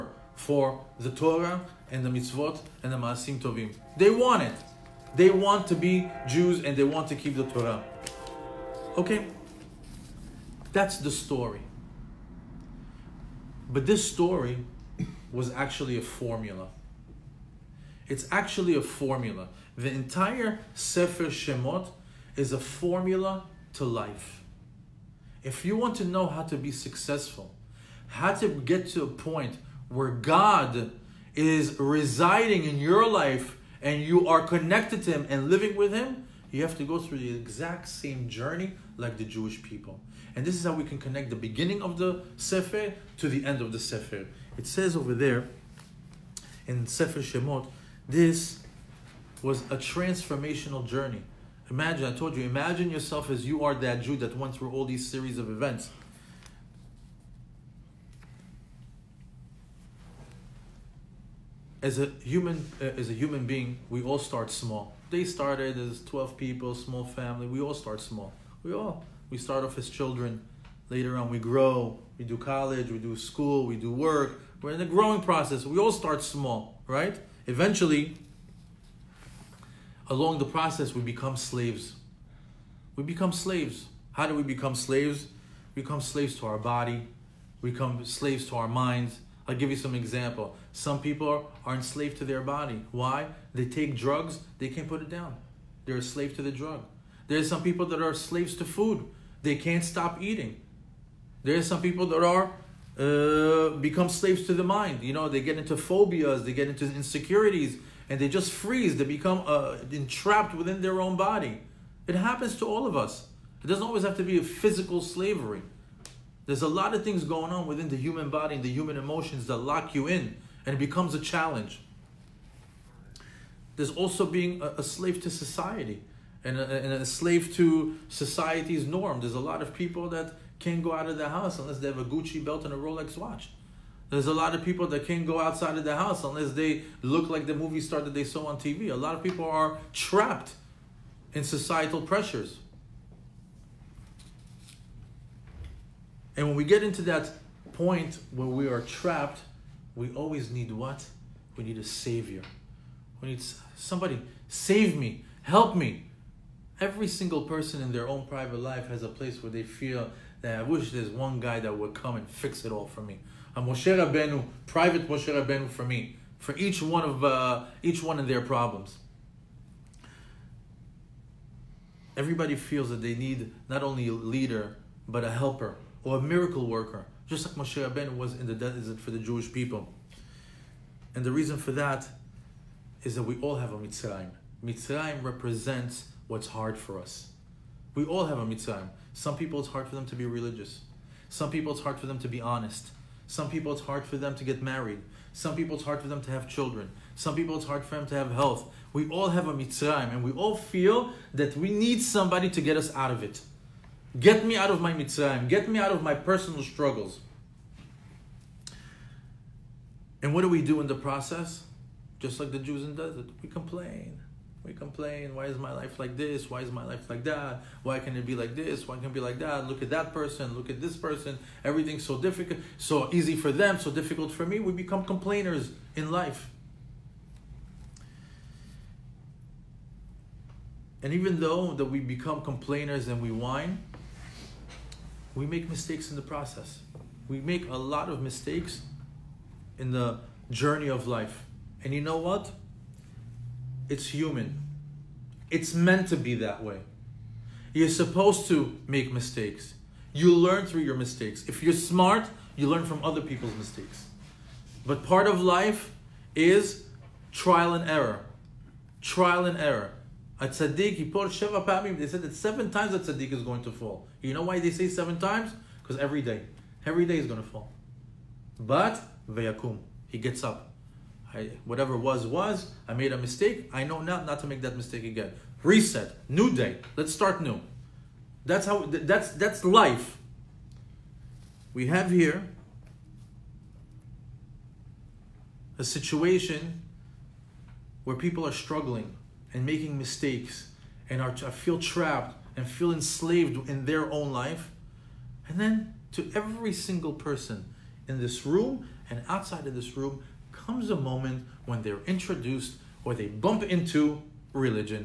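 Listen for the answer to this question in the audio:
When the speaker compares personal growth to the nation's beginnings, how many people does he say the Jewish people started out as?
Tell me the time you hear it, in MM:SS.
01:06.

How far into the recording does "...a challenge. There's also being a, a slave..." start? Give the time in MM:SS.
02:01.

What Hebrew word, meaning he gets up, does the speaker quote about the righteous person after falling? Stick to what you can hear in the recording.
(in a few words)
Vayakum.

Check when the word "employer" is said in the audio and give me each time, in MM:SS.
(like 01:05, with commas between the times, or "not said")
not said.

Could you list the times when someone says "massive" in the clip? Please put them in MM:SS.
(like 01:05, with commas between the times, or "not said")
not said.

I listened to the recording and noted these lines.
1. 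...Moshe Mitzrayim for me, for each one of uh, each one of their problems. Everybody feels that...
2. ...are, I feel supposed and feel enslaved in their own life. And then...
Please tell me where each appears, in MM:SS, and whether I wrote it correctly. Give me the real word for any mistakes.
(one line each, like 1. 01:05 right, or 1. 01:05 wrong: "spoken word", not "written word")
1. 02:45 wrong: "Rabbeinu", not "Mitzrayim"
2. 04:51 wrong: "trapped", not "supposed".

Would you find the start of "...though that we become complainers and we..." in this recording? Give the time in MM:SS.
03:51.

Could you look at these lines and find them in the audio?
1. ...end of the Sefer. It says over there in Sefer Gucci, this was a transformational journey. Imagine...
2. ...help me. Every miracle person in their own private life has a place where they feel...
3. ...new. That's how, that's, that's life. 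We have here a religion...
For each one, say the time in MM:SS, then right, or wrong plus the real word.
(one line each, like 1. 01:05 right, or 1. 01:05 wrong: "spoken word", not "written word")
1. 00:43 wrong: "Shemot", not "Gucci"
2. 02:35 wrong: "single", not "miracle"
3. 04:37 wrong: "situation", not "religion".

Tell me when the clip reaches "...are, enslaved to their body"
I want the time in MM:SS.
01:31.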